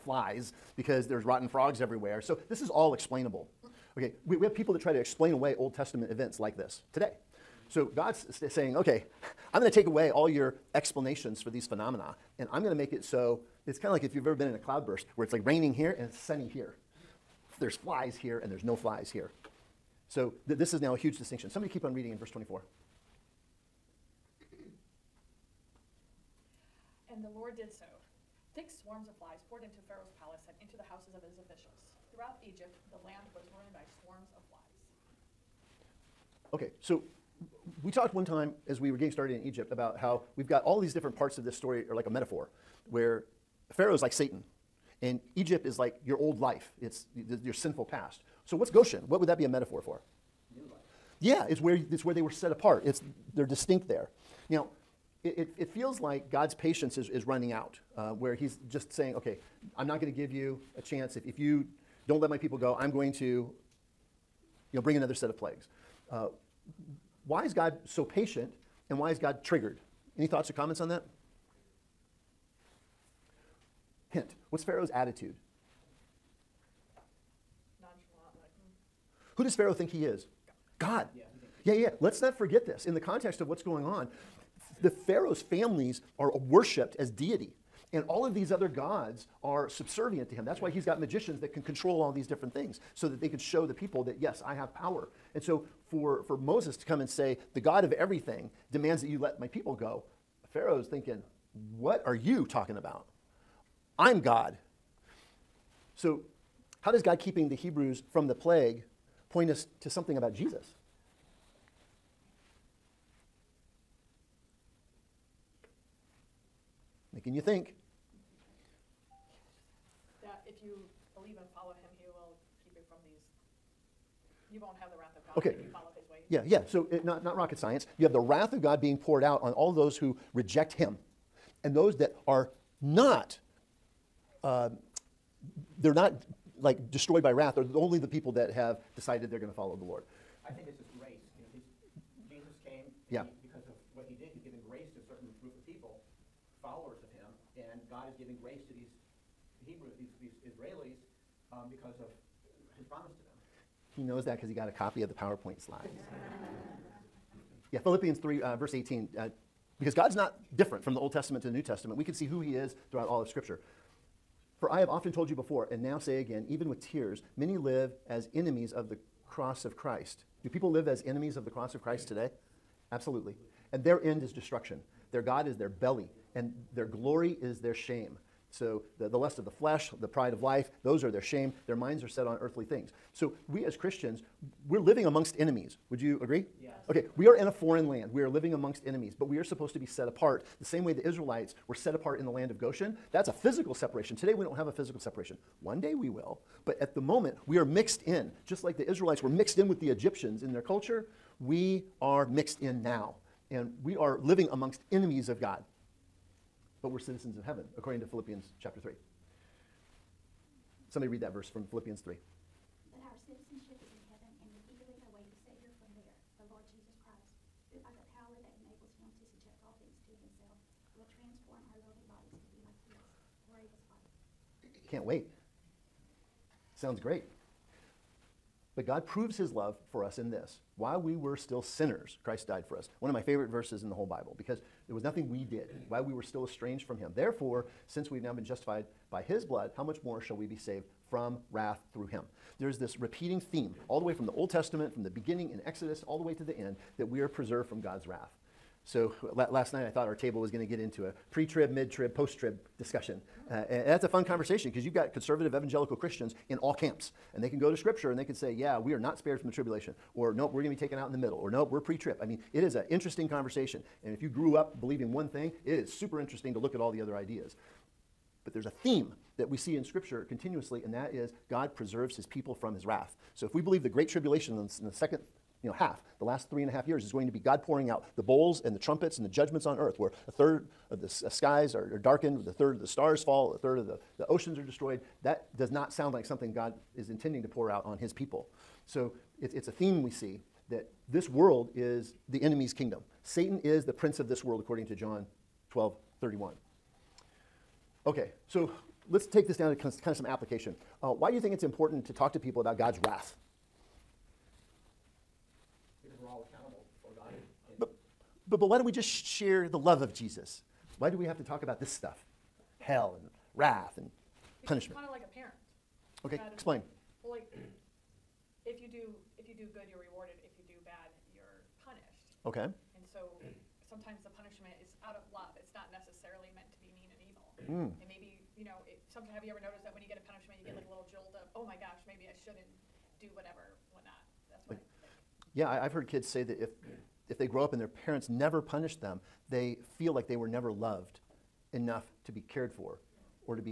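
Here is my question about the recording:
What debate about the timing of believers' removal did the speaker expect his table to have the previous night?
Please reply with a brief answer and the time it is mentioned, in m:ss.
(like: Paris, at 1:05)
pre trib, mid trib, post trib, at 4:11.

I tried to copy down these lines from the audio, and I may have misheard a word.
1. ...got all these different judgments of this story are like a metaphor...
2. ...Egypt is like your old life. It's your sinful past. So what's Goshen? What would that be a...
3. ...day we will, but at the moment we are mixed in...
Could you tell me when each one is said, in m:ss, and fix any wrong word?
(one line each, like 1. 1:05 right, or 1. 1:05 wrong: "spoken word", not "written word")
1. 0:40 wrong: "parts", not "judgments"
2. 0:45 right
3. 3:15 right.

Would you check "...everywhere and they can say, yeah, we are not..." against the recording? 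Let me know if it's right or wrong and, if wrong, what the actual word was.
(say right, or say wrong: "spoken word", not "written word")
wrong: "scripture", not "everywhere".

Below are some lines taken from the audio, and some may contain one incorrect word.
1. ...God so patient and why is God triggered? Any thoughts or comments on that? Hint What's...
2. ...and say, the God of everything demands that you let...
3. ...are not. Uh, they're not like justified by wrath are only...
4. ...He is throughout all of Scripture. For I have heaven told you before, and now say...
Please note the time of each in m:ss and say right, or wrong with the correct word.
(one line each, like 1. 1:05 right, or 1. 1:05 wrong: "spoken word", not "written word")
1. 1:07 right
2. 1:37 right
3. 2:12 wrong: "destroyed", not "justified"
4. 2:42 wrong: "often", not "heaven".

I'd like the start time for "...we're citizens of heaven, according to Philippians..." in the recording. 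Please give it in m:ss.
3:26.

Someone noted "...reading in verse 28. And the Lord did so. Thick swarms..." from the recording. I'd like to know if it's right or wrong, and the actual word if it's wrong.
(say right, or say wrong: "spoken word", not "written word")
wrong: "24", not "28".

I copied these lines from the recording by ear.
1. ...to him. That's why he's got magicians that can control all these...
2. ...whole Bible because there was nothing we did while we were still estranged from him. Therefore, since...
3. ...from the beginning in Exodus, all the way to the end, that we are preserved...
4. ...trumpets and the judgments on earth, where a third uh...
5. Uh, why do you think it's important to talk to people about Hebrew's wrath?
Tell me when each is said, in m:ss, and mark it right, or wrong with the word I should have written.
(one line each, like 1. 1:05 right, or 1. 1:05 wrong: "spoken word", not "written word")
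1. 1:30 right
2. 3:53 right
3. 4:04 right
4. 4:38 right
5. 5:01 wrong: "God", not "Hebrew".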